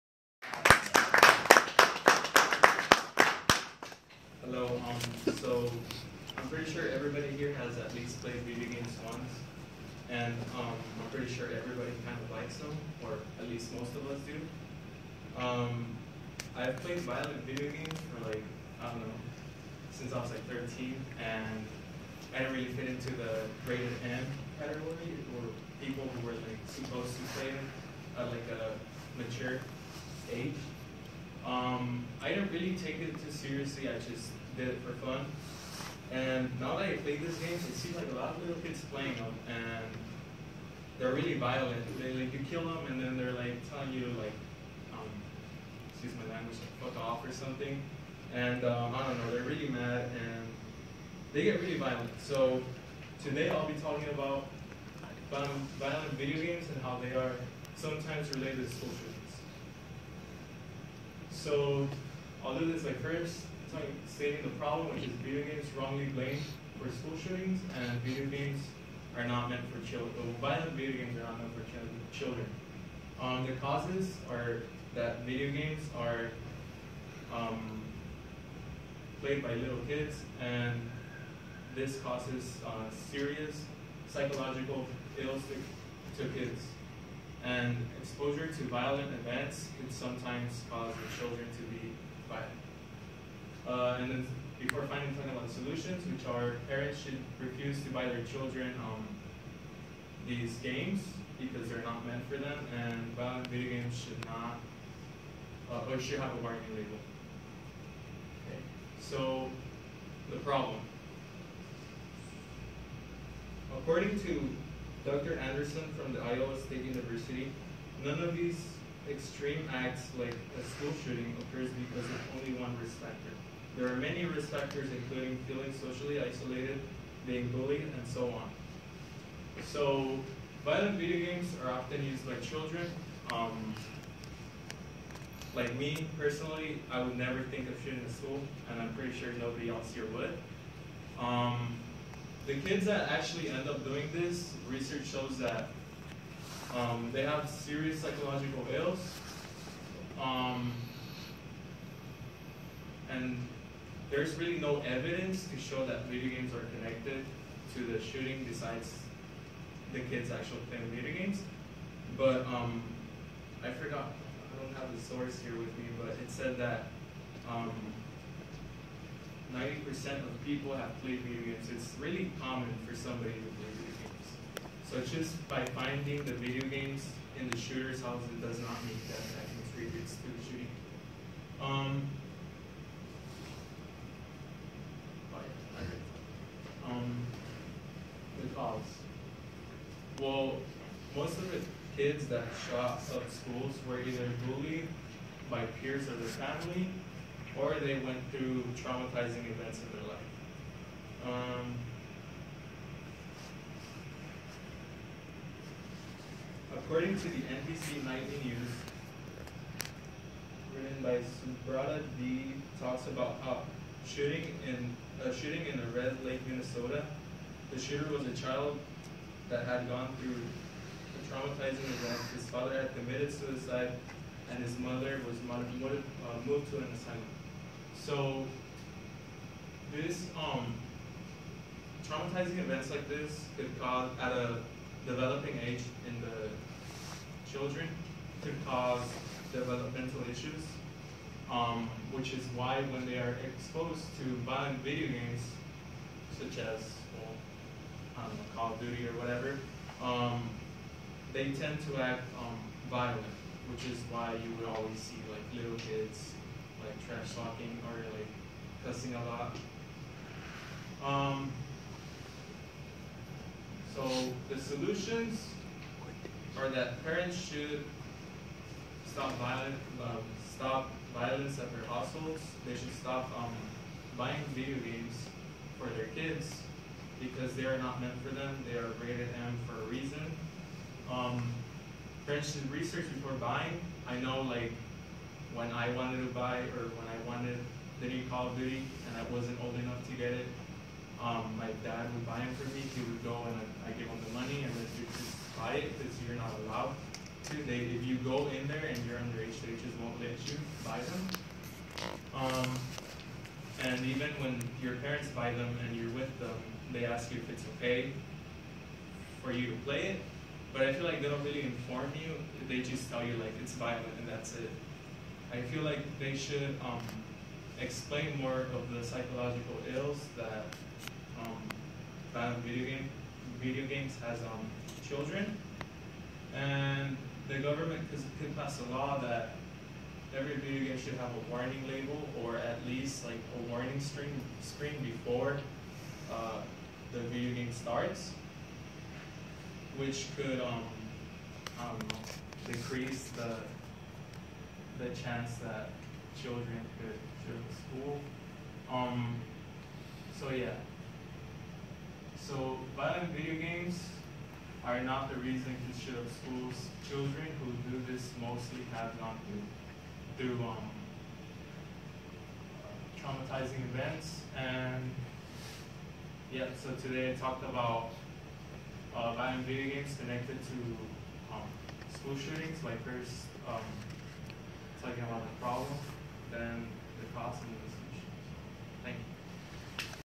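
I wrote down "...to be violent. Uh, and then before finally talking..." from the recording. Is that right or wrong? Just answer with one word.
right.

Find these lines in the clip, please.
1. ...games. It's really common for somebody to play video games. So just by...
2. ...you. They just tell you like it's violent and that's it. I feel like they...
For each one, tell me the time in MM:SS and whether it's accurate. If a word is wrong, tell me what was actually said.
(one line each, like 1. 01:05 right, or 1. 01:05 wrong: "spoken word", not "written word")
1. 02:51 right
2. 05:12 right.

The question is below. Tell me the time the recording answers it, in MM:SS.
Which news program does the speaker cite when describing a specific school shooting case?
03:27.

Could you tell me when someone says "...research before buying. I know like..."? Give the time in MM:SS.
04:42.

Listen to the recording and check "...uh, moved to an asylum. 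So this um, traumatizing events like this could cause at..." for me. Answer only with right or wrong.
right.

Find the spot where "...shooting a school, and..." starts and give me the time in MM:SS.
02:17.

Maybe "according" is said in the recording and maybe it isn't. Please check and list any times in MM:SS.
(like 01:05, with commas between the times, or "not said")
01:53, 03:26.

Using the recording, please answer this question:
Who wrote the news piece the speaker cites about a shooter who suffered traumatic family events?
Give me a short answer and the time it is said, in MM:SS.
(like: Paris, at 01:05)
Subrata De, at 03:31.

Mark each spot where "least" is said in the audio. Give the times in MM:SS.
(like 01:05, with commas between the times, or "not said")
00:07, 00:13, 05:32.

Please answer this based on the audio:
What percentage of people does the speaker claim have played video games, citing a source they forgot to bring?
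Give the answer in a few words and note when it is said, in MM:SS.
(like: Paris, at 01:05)
90%, at 02:47.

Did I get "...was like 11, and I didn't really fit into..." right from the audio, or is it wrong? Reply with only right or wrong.
wrong.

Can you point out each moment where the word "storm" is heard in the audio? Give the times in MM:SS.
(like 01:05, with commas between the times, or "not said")
not said.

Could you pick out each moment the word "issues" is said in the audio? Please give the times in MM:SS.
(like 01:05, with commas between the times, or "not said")
00:58, 04:00.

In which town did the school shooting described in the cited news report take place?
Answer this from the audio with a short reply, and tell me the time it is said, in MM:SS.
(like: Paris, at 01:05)
Red Lake, Minnesota, at 03:35.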